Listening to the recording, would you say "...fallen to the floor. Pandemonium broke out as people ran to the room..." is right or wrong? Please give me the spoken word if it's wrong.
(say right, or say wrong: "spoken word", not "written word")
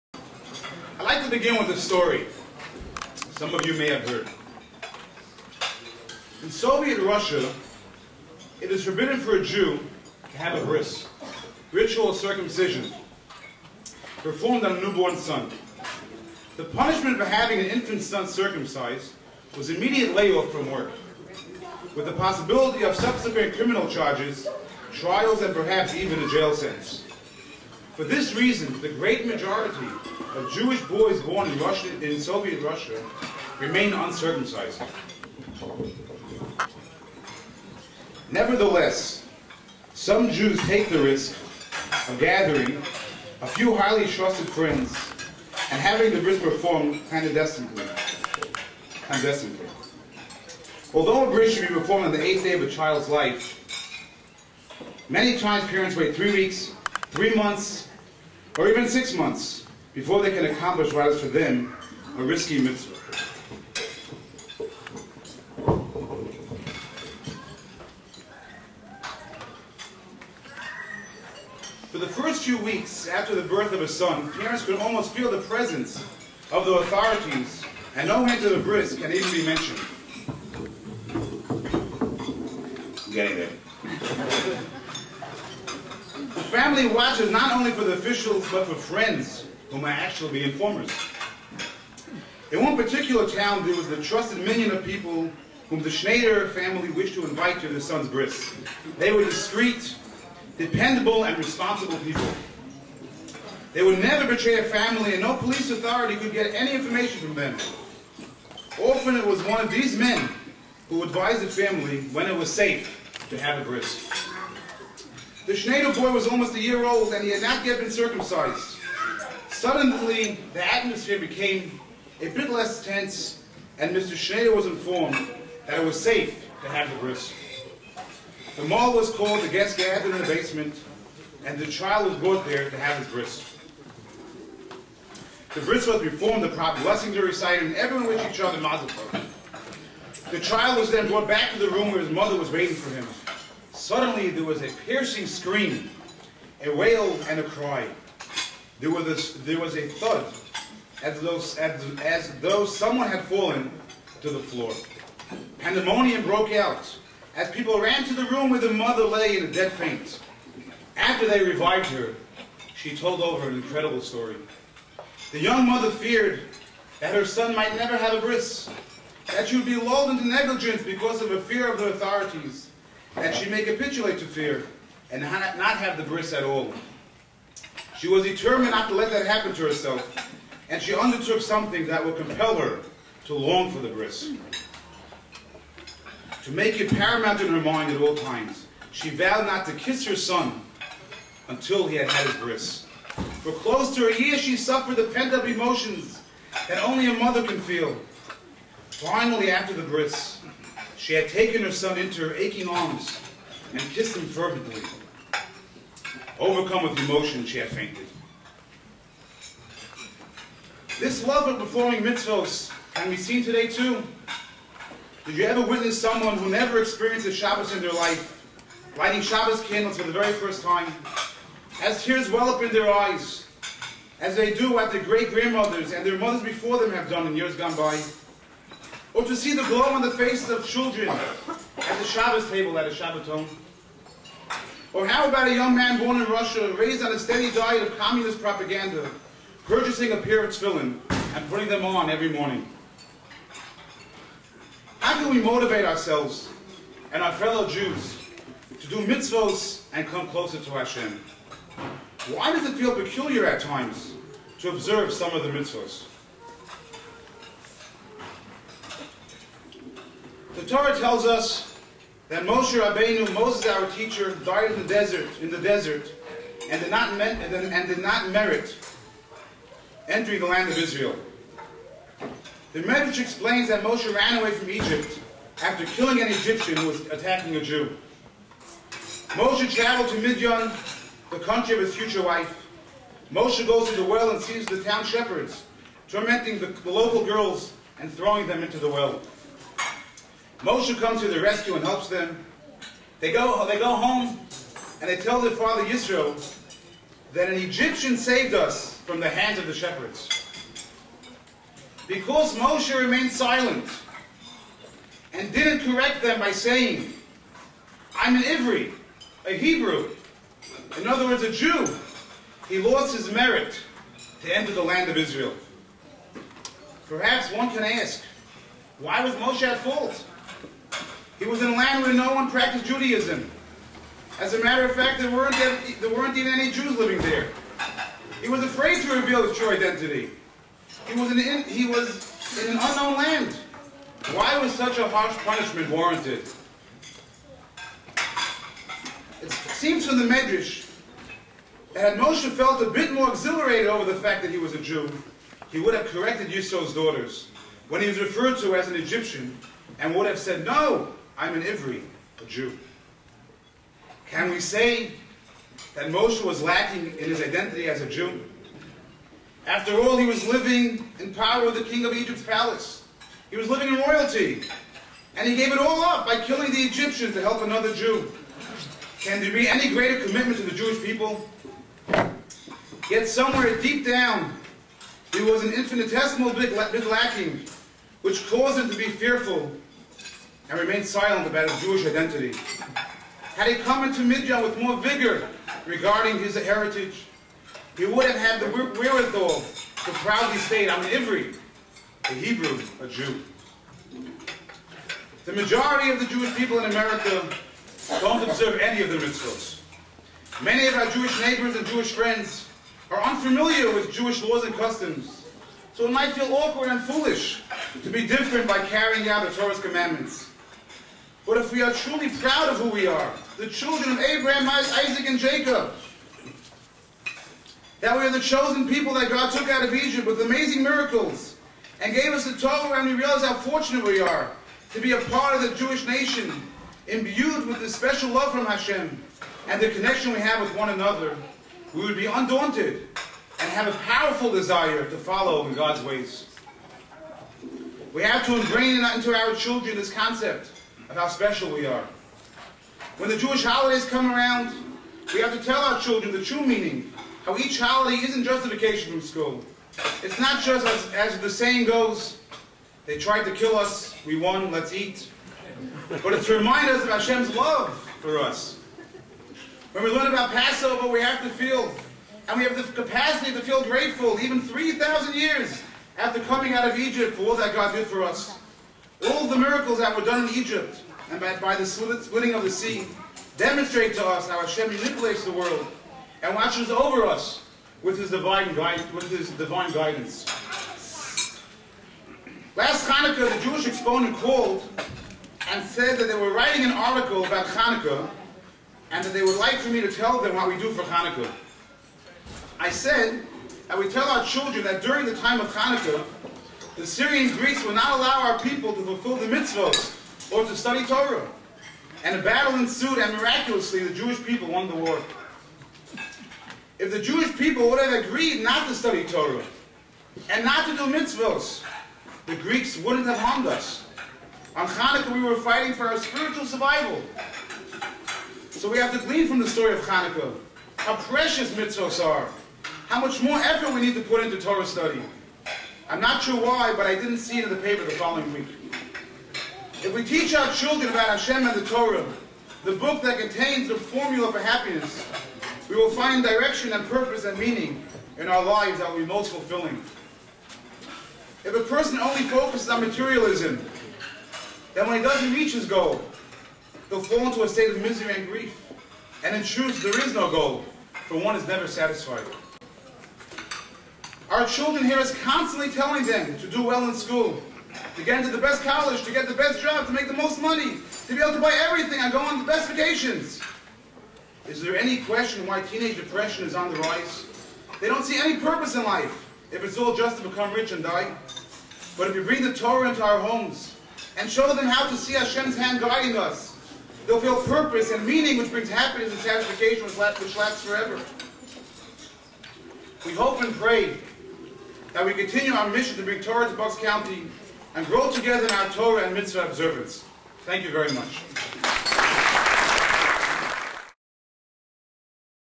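right.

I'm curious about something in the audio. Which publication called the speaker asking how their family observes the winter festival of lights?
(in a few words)
the Jewish Exponent.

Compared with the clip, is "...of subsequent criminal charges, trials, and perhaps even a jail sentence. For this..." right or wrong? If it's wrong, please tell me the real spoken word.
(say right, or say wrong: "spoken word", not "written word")
right.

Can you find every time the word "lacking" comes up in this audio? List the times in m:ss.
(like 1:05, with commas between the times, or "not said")
5:56, 6:17.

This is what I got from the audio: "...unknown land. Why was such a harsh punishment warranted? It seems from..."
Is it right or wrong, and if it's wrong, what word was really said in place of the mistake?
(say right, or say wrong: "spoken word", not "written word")
right.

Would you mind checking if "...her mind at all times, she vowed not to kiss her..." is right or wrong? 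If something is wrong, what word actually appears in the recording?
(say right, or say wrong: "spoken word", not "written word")
right.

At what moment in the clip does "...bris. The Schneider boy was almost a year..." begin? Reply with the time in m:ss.
1:53.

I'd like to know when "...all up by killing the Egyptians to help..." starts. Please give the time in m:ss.
6:05.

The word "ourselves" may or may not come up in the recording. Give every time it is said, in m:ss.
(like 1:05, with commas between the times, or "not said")
4:05.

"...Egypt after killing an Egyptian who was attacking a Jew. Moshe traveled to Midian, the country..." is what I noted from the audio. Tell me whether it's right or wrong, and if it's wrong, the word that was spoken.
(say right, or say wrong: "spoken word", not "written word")
right.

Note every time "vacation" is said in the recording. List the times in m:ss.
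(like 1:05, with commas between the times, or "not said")
7:28, 9:22.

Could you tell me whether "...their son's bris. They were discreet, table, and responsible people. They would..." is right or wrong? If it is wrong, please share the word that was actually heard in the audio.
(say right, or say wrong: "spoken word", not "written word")
wrong: "dependable", not "table".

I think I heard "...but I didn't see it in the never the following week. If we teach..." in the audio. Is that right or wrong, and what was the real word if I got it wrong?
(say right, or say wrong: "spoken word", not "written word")
wrong: "paper", not "never".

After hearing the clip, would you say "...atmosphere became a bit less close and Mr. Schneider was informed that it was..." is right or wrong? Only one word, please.
wrong.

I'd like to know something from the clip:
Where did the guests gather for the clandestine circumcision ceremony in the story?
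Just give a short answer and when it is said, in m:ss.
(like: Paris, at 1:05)
the basement, at 2:10.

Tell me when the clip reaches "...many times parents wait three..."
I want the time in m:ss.
0:55.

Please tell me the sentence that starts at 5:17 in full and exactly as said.
Perhaps one can ask, why was Moshe at fault?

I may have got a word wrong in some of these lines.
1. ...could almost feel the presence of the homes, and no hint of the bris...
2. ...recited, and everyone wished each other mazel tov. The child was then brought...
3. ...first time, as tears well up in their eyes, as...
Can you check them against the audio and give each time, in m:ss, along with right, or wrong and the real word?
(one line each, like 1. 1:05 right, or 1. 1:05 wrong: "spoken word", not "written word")
1. 1:14 wrong: "authorities", not "homes"
2. 2:17 right
3. 3:40 right.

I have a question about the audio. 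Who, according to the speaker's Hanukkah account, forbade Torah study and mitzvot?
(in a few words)
the Syrian Greeks.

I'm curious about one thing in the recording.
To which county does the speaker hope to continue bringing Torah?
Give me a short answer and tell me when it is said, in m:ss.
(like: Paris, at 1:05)
Bucks County, at 9:46.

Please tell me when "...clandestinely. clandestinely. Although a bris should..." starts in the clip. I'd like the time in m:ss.
0:47.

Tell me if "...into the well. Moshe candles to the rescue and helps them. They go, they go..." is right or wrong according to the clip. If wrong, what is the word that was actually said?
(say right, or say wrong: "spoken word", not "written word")
wrong: "comes", not "candles".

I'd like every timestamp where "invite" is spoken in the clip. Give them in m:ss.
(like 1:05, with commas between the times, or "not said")
1:37.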